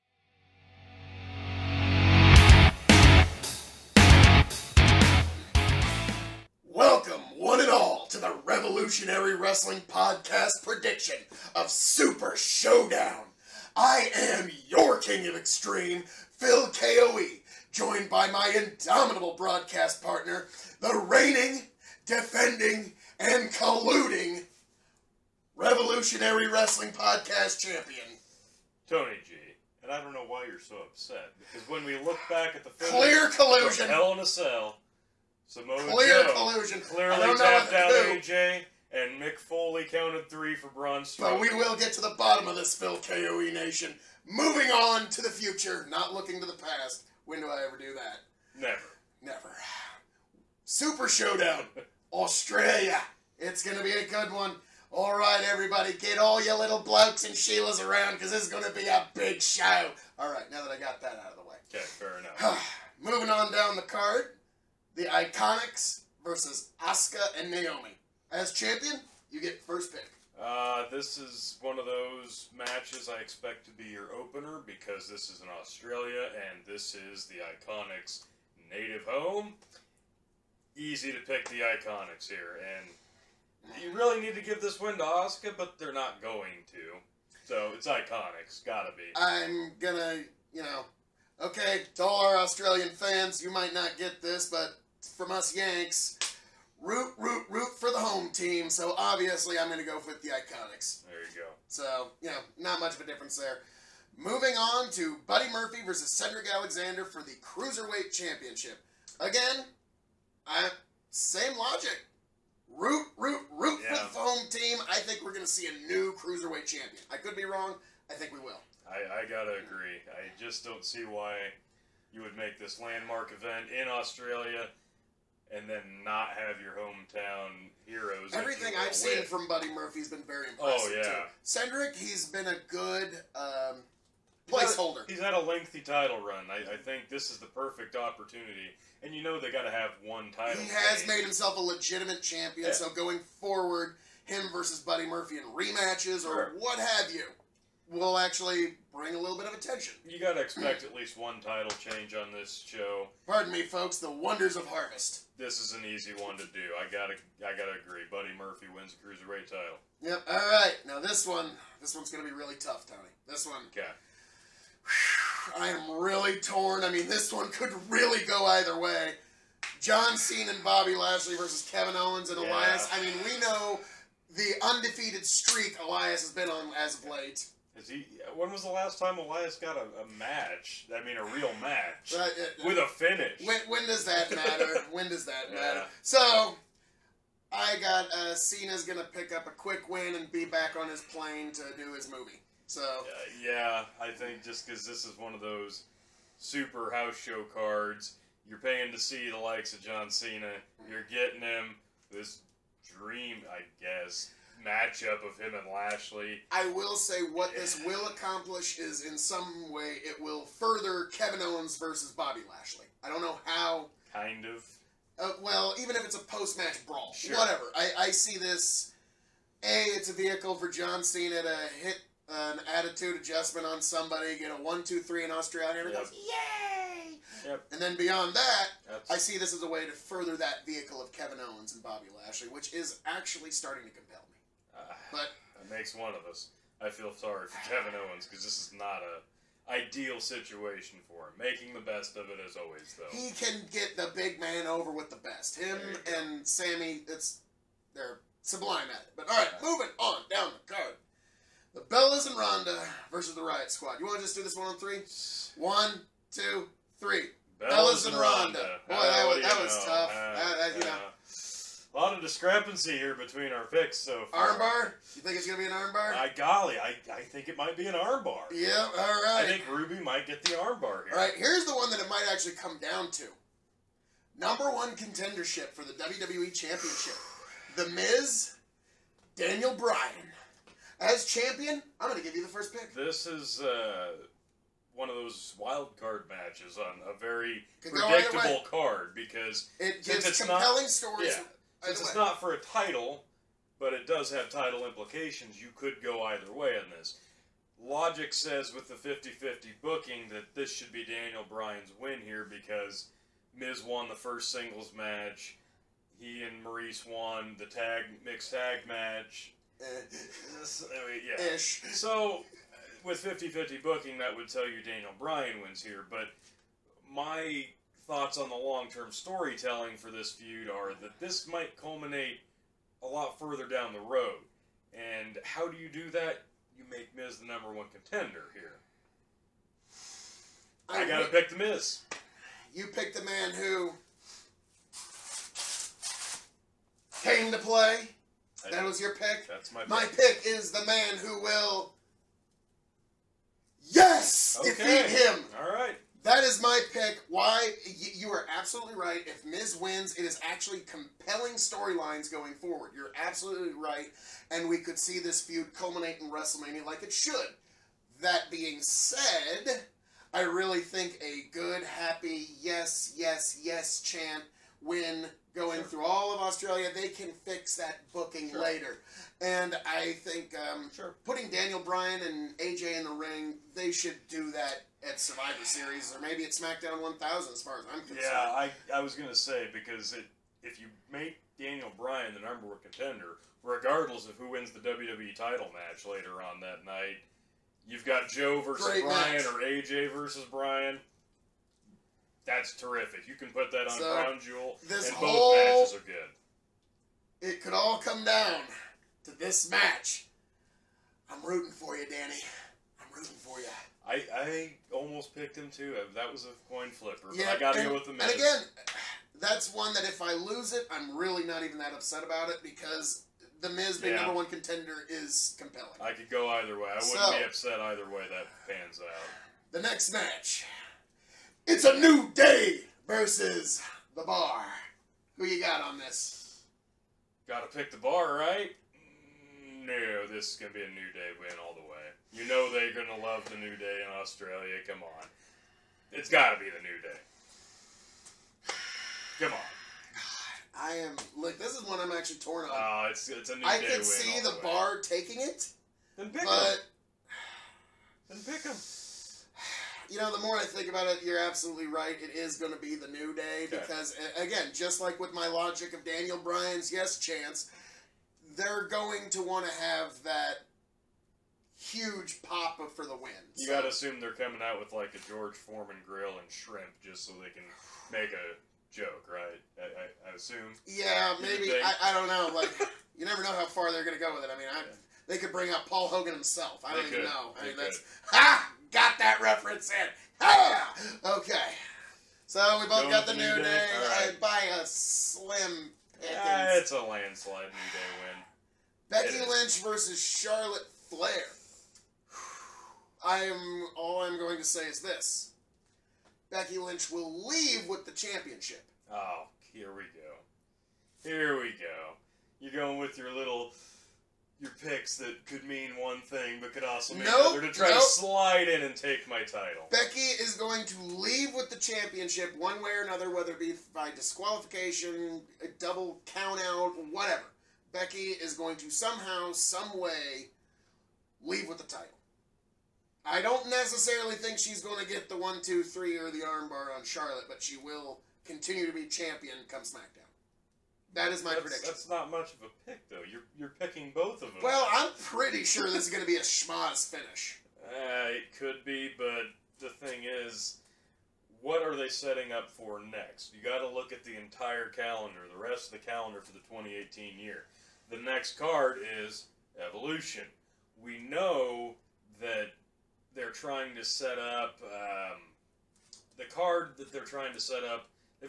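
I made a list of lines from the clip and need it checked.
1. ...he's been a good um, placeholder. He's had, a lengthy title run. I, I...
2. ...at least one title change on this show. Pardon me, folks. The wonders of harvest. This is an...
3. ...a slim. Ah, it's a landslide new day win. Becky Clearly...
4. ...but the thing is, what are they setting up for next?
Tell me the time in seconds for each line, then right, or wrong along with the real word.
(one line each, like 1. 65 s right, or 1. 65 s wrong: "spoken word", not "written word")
1. 131 s right
2. 150 s right
3. 484 s wrong: "Lynch", not "Clearly"
4. 539 s right.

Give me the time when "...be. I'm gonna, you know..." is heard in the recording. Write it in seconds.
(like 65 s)
88 s.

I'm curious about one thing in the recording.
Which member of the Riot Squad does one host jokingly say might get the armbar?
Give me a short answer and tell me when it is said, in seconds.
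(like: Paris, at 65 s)
Ruby, at 269 s.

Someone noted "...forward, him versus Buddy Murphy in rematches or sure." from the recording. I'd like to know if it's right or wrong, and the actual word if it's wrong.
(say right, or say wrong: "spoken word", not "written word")
right.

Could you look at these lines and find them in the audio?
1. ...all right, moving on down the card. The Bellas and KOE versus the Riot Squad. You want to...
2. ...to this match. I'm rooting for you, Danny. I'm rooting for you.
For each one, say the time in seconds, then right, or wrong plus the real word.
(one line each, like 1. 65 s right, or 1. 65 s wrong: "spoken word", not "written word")
1. 249 s wrong: "Ronda", not "KOE"
2. 399 s right.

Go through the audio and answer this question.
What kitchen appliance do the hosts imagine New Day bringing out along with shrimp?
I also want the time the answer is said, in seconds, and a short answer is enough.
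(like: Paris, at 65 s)
George Foreman grill, at 465 s.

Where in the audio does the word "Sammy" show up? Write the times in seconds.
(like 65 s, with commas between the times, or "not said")
246 s.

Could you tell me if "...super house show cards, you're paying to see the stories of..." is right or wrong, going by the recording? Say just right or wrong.
wrong.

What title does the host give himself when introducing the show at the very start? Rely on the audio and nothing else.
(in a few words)
King of Extreme.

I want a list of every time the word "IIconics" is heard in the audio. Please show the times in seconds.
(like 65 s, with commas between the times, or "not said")
65 s, 77 s, 81 s, 87 s, 100 s.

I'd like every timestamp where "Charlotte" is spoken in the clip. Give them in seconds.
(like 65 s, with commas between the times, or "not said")
490 s, 527 s.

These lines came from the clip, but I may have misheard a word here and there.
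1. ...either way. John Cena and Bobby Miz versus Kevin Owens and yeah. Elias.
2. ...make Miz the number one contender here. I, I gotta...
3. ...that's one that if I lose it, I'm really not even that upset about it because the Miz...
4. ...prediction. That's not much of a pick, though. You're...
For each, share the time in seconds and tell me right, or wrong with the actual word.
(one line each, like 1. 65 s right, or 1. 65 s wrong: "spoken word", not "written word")
1. 168 s wrong: "Lashley", not "Miz"
2. 326 s right
3. 409 s right
4. 531 s right.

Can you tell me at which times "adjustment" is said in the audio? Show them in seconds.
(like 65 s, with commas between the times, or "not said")
223 s.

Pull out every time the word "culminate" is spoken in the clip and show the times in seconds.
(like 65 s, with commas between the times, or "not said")
321 s, 355 s.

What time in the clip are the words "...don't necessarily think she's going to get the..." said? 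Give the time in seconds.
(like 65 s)
523 s.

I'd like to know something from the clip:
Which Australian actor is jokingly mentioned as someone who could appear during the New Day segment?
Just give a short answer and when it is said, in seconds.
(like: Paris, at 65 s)
Paul Hogan, at 475 s.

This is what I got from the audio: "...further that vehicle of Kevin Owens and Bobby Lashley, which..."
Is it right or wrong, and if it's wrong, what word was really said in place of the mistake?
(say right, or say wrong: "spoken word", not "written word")
right.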